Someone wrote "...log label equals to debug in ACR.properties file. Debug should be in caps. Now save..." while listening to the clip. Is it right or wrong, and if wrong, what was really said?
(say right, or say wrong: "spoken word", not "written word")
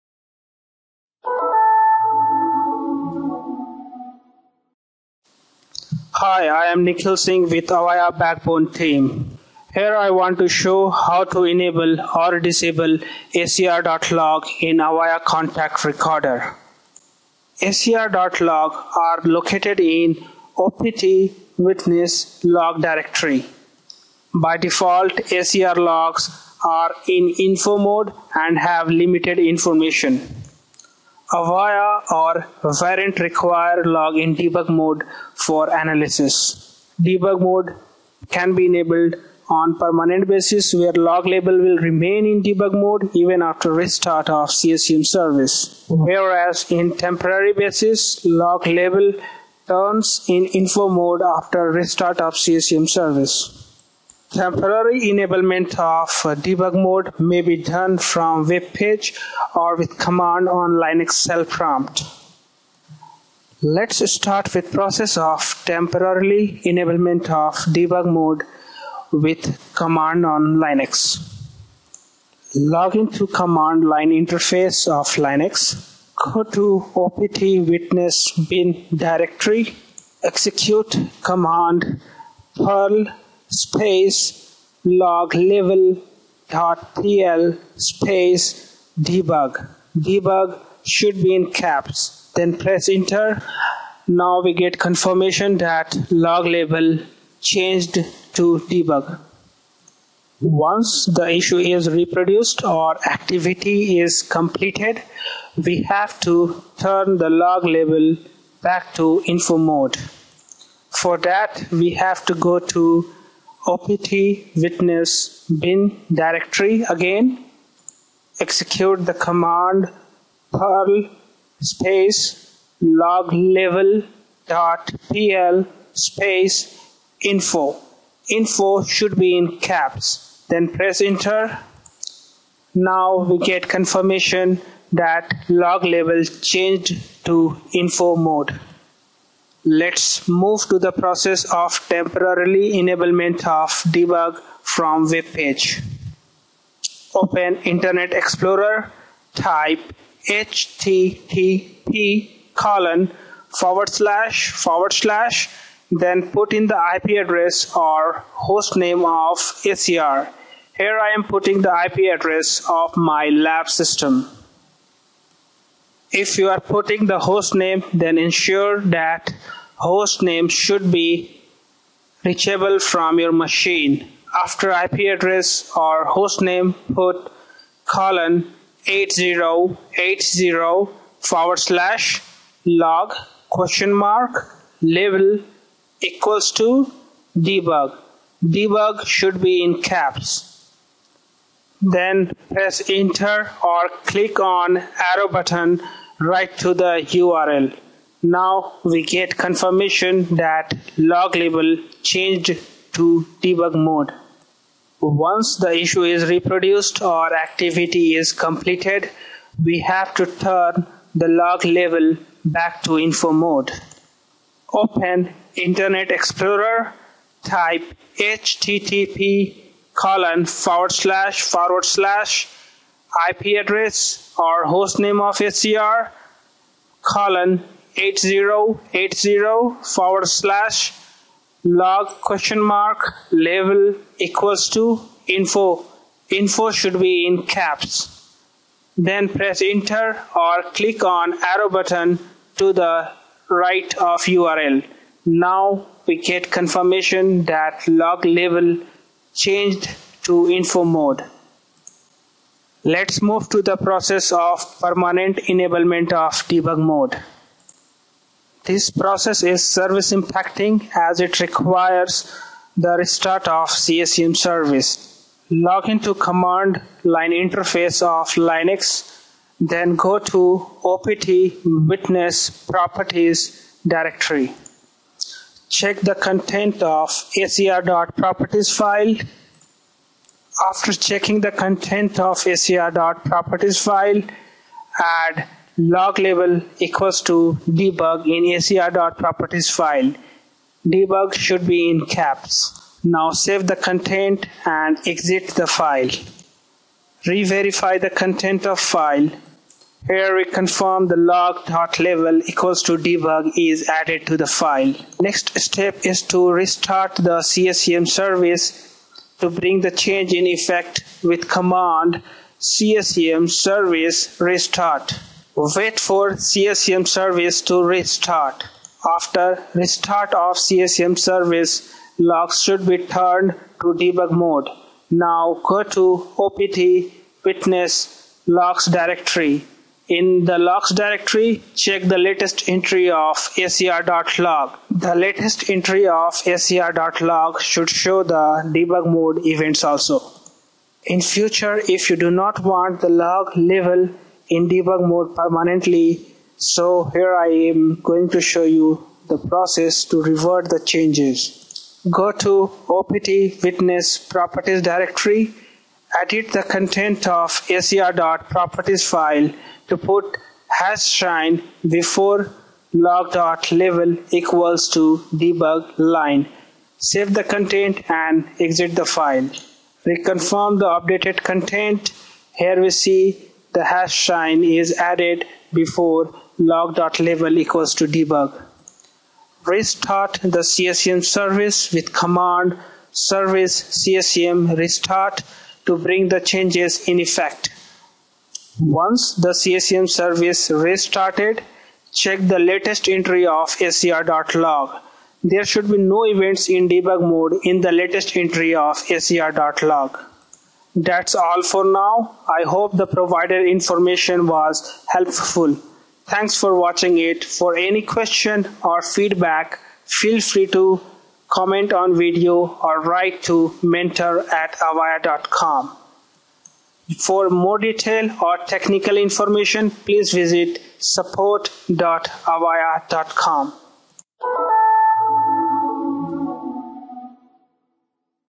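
right.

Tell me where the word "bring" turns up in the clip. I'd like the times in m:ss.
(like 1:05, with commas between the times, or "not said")
5:09, 6:25.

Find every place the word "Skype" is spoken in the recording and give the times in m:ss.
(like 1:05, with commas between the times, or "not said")
not said.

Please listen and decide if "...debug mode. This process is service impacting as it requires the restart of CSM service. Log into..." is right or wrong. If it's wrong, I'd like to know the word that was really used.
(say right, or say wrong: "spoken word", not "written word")
right.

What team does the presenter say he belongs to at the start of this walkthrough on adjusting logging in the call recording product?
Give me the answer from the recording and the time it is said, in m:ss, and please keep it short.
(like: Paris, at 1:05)
Avaya Backbone team, at 0:07.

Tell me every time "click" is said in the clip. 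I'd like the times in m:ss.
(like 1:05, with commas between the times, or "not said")
3:14, 4:00.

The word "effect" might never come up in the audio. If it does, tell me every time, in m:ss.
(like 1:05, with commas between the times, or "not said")
5:10, 6:27.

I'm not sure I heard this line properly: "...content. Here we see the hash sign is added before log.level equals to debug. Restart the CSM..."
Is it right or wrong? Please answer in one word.
right.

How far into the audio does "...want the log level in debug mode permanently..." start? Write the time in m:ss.
5:42.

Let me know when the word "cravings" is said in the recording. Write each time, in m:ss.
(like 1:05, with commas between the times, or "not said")
not said.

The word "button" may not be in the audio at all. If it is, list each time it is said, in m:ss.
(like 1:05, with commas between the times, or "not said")
3:15, 4:01.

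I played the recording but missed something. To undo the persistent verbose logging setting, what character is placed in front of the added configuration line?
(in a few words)
hash sign.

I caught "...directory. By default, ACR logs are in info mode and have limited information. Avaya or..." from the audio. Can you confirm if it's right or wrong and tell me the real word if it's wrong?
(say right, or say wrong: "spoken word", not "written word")
right.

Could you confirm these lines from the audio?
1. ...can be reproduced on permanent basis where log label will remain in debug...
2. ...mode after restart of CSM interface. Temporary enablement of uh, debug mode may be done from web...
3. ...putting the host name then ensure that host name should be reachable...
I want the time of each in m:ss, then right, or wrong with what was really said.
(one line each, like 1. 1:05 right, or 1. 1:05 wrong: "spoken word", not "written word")
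1. 0:38 wrong: "enabled", not "reproduced"
2. 0:50 wrong: "service", not "interface"
3. 2:46 right.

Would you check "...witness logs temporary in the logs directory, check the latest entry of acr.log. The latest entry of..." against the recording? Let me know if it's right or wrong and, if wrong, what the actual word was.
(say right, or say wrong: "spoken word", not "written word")
wrong: "directory", not "temporary".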